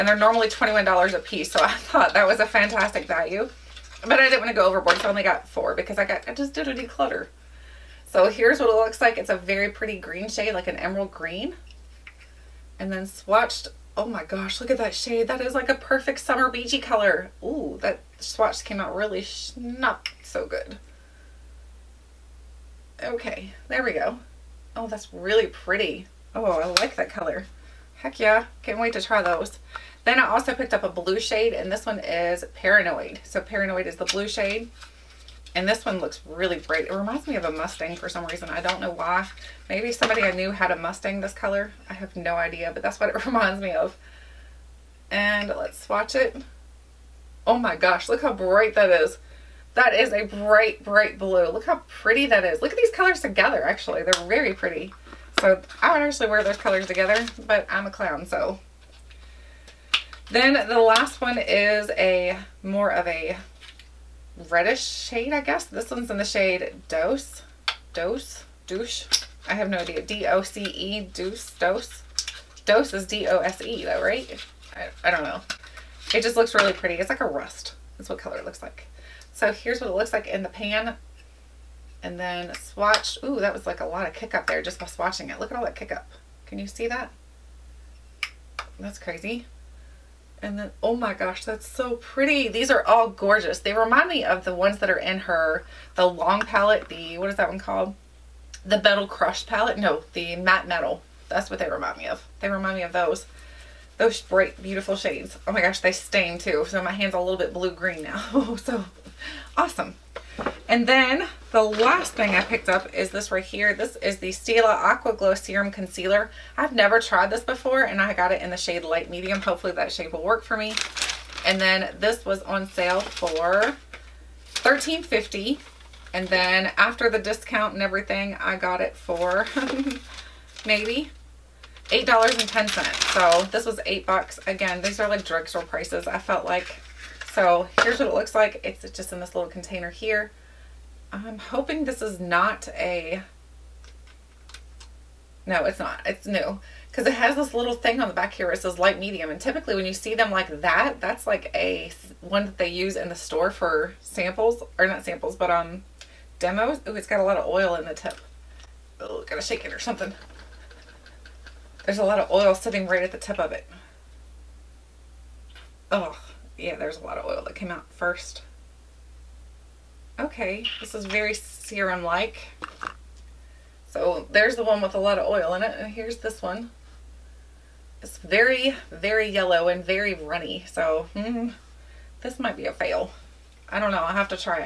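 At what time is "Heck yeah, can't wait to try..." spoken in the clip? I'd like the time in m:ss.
0:27.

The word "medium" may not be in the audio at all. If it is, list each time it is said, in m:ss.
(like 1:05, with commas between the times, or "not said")
1:59, 2:28.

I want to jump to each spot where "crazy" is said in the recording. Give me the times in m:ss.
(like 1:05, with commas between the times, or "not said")
1:28.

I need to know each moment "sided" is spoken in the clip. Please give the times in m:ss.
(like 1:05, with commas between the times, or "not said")
not said.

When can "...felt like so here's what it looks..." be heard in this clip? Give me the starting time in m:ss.
2:16.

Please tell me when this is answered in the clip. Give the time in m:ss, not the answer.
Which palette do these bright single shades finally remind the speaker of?
1:40.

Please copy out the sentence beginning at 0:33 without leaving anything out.
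So Paranoid is the blue shade.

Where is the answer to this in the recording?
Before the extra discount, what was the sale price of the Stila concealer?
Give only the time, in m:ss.
2:04.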